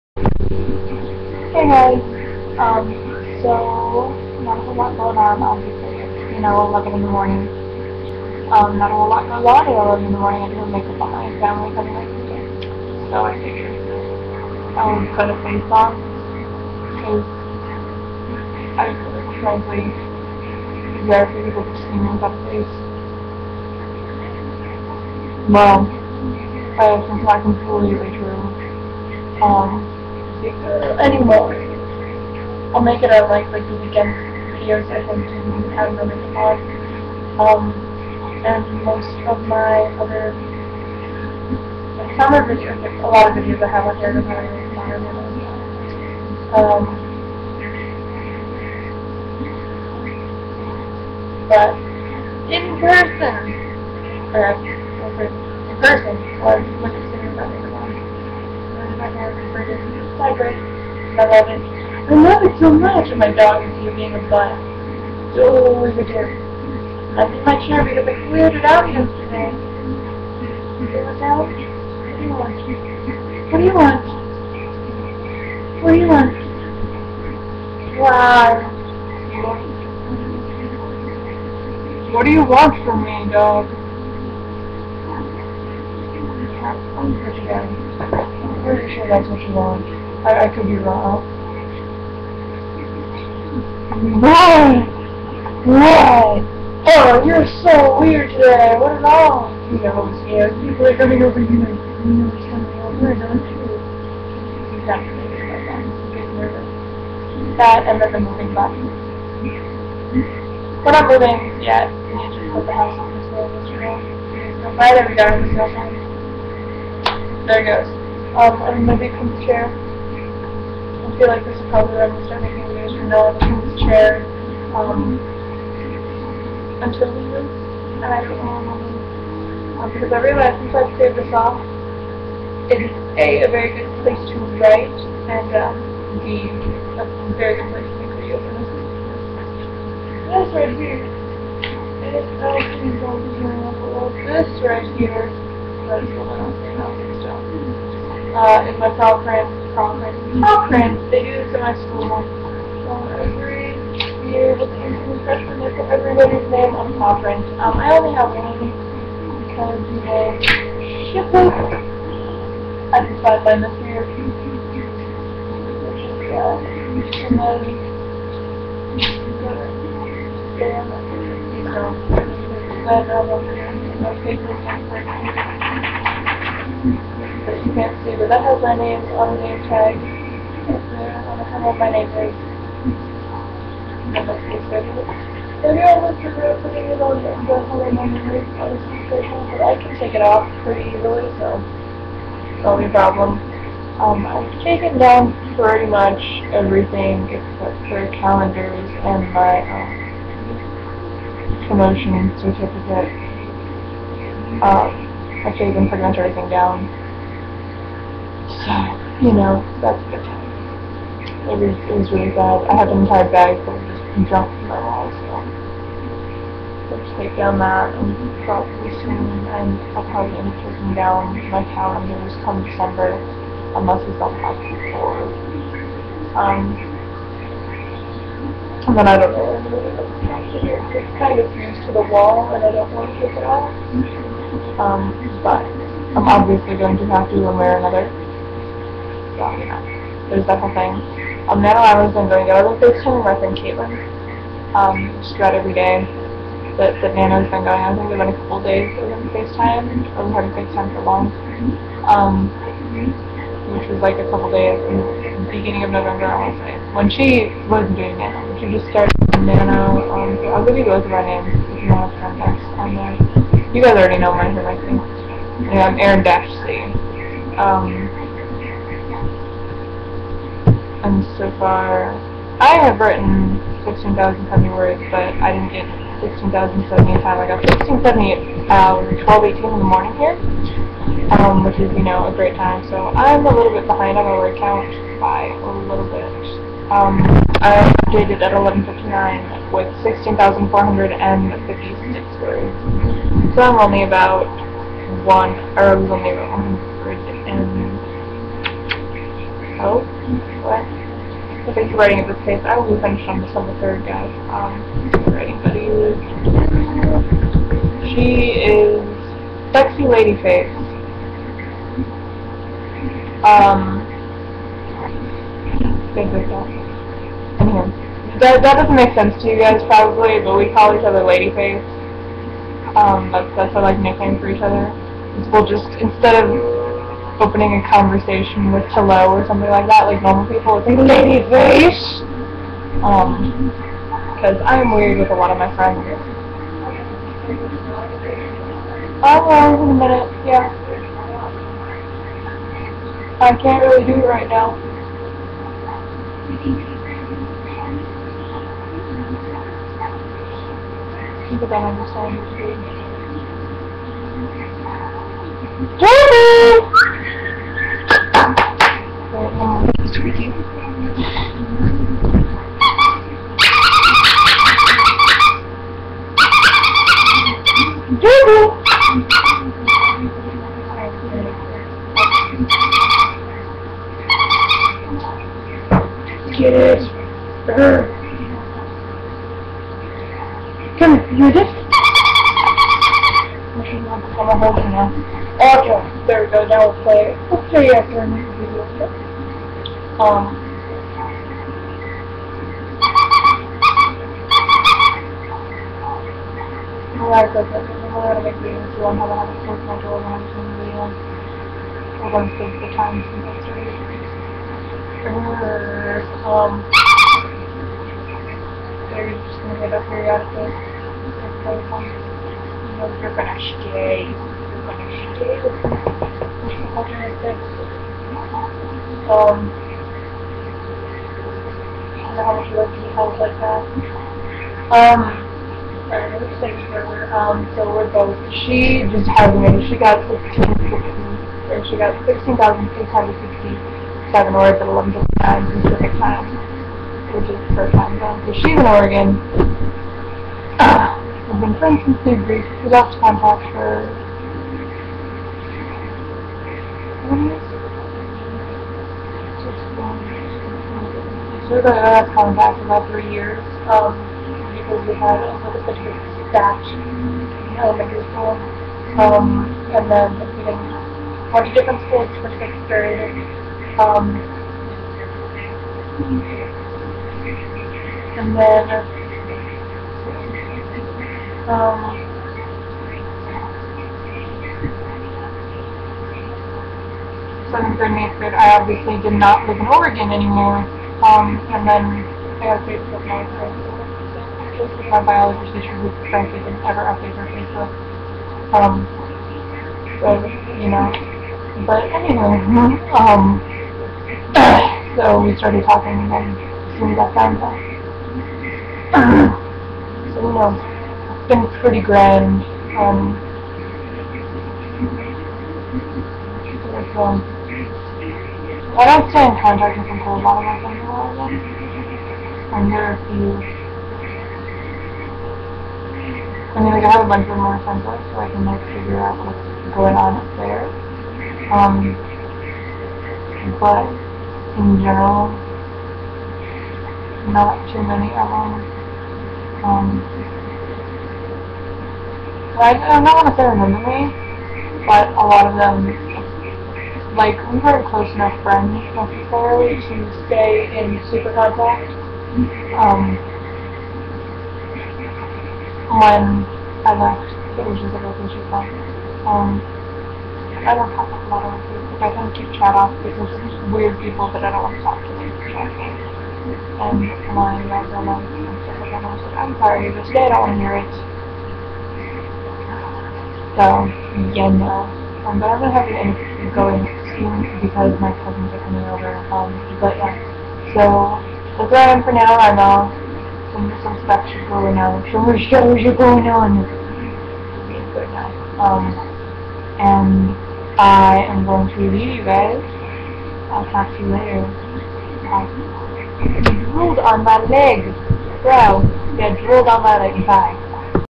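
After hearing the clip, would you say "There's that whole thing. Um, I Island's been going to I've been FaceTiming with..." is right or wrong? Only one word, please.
right.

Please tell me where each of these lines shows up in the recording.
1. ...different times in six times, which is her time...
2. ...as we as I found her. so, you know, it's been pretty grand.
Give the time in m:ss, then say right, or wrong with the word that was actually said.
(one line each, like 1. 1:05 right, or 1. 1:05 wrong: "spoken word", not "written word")
1. 7:15 right
2. 8:16 right.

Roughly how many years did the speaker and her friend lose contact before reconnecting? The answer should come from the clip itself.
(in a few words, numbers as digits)
3 years.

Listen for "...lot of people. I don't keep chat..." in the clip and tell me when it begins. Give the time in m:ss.
9:11.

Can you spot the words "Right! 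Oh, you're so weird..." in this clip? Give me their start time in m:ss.
1:35.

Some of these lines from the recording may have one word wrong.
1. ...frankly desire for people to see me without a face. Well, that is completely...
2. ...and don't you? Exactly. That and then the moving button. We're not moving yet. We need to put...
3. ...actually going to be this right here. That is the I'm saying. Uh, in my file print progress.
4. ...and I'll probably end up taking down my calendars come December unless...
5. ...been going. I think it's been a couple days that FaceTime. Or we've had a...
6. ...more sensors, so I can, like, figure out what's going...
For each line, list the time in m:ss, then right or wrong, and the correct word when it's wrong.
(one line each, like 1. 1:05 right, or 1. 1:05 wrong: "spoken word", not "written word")
1. 0:19 right
2. 1:43 right
3. 2:22 right
4. 3:39 right
5. 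4:07 right
6. 8:37 right.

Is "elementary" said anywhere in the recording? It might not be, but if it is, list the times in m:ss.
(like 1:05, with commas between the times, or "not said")
7:37.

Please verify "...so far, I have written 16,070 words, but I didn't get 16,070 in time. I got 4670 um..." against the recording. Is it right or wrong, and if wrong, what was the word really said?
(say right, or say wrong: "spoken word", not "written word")
wrong: "1670", not "4670".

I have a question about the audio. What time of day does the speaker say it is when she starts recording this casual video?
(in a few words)
11 in the morning.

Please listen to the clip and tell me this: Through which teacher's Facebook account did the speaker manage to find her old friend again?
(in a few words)
biology teacher.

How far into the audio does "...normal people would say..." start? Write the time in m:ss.
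5:30.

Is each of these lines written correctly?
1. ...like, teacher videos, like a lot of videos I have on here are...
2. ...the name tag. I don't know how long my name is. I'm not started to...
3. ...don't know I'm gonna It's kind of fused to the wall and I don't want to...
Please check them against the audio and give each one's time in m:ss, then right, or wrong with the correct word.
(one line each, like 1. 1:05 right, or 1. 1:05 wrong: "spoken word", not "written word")
1. 0:41 wrong: "summer", not "teacher"
2. 2:59 wrong: "supposed", not "started"
3. 3:49 right.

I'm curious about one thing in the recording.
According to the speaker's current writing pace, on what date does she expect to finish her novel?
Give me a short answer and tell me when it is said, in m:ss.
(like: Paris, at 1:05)
December 3rd, at 5:03.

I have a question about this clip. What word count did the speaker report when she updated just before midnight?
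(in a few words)
16,456.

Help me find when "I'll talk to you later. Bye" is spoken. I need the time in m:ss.
9:43.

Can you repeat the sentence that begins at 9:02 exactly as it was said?
Um, when I left, it was just a relationship.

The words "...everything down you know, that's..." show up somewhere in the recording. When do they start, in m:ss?
3:26.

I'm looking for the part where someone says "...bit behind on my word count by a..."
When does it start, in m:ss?
4:43.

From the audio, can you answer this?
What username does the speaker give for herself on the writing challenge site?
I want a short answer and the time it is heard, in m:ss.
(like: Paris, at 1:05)
Erin Dash C, at 4:25.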